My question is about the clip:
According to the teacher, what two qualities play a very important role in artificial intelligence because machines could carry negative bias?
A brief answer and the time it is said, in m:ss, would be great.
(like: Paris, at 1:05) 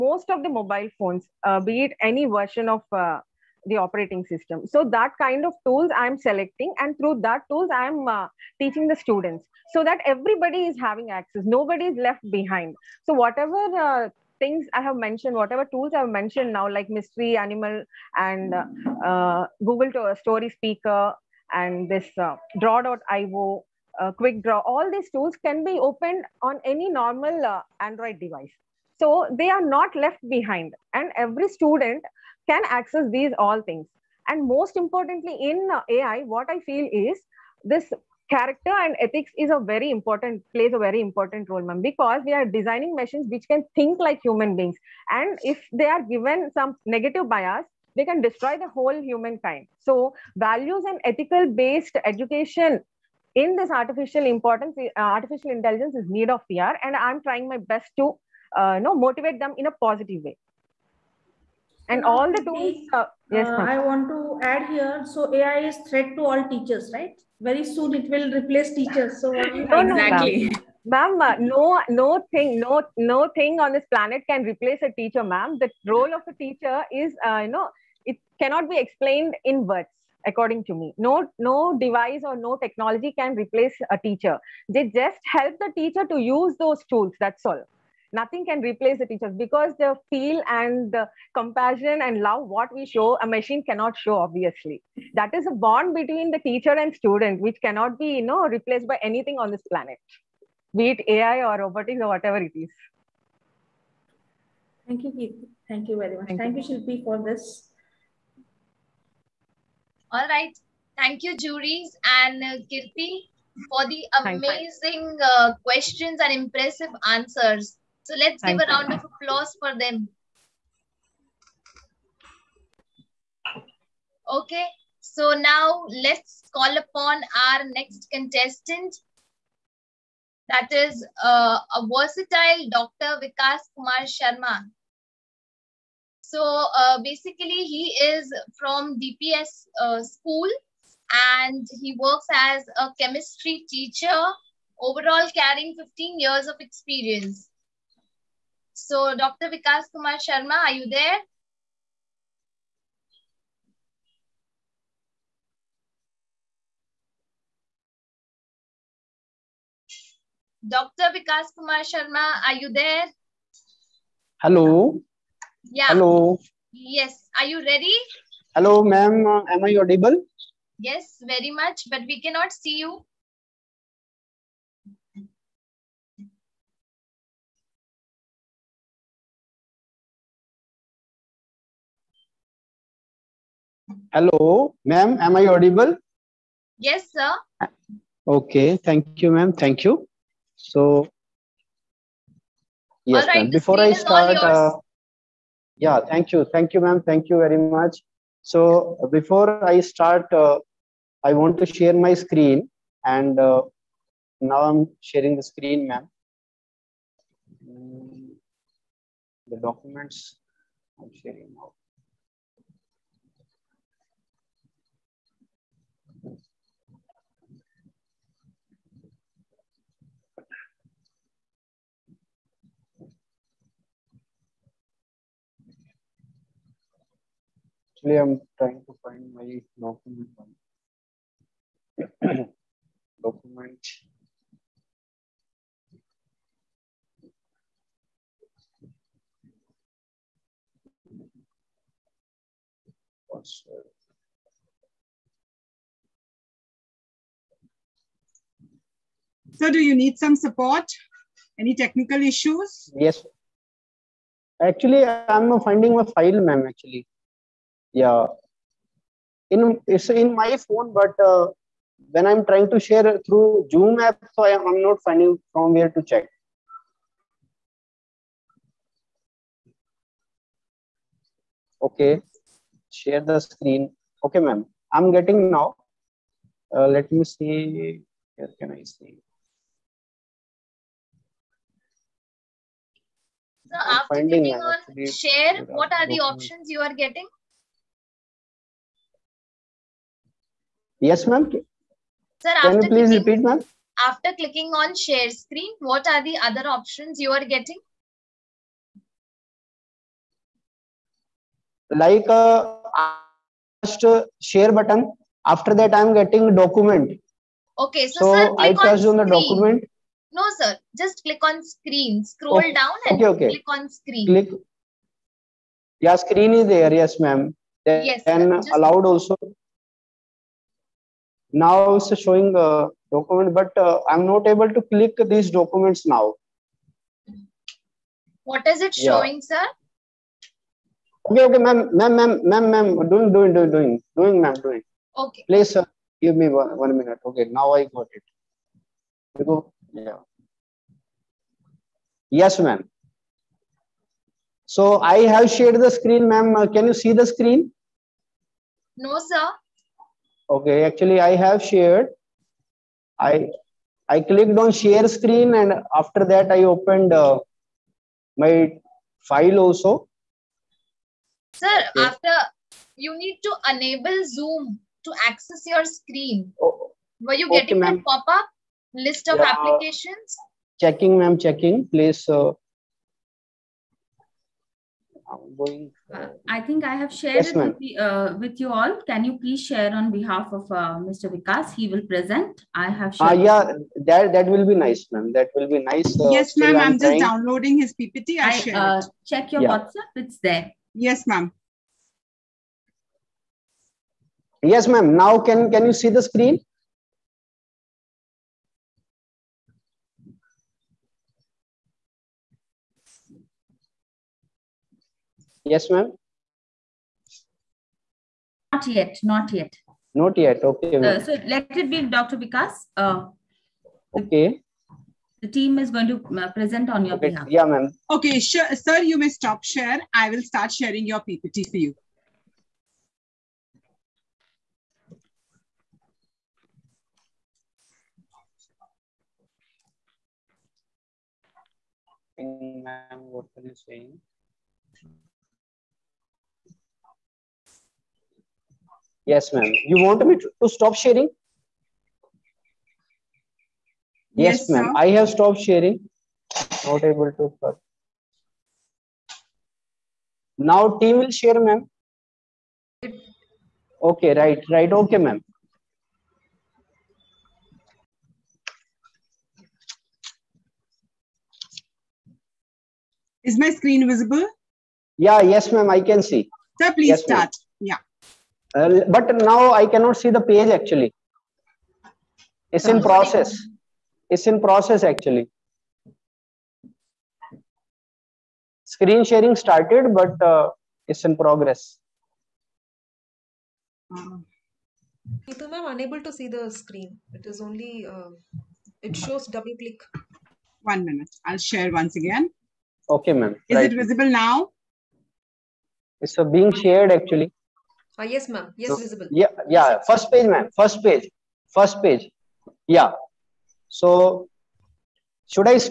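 Character and ethics, at 0:38.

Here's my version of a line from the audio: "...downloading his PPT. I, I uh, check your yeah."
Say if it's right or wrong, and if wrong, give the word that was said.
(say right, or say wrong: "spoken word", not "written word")
right.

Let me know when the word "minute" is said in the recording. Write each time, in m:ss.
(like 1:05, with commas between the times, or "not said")
5:36, 8:11.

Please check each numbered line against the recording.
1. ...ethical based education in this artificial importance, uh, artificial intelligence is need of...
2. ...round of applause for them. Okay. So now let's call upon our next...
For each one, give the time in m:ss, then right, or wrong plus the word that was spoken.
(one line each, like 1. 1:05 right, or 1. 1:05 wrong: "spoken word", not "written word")
1. 0:51 right
2. 1:58 right.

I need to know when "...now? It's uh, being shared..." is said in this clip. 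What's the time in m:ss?
8:14.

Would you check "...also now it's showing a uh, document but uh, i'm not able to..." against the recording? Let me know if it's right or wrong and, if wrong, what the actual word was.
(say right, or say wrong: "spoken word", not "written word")
right.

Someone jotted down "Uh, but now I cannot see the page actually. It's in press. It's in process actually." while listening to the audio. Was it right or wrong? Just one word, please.
wrong.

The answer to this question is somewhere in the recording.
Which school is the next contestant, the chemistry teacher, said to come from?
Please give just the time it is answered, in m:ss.
2:18.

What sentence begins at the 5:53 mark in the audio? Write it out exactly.
I I clicked on share screen and after that I opened uh, my file also.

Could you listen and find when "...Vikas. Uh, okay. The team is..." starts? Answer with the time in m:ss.
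6:52.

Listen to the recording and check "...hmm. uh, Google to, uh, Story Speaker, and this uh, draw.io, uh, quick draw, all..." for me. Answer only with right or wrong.
right.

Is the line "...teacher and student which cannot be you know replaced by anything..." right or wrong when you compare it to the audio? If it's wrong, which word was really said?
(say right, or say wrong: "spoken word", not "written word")
right.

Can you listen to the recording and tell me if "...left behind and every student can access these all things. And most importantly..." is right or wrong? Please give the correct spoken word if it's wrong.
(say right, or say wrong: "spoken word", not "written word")
right.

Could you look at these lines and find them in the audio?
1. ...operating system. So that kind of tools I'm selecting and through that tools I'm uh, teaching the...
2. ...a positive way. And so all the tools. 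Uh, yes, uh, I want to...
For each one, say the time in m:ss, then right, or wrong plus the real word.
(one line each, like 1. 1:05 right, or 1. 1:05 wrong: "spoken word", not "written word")
1. 0:03 right
2. 0:59 right.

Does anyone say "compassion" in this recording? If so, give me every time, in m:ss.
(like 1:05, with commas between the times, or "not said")
1:31.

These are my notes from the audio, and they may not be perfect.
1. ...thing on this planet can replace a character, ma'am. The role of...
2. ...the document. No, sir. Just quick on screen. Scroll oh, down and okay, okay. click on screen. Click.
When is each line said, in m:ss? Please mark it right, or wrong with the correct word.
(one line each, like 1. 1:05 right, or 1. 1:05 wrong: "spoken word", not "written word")
1. 1:13 wrong: "teacher", not "character"
2. 5:09 wrong: "click", not "quick".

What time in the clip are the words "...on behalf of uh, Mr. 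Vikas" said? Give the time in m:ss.
6:19.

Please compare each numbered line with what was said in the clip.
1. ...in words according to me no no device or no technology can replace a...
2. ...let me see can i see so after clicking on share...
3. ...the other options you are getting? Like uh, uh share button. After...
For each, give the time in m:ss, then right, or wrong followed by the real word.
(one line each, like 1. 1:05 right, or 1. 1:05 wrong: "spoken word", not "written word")
1. 1:19 right
2. 4:36 right
3. 4:56 right.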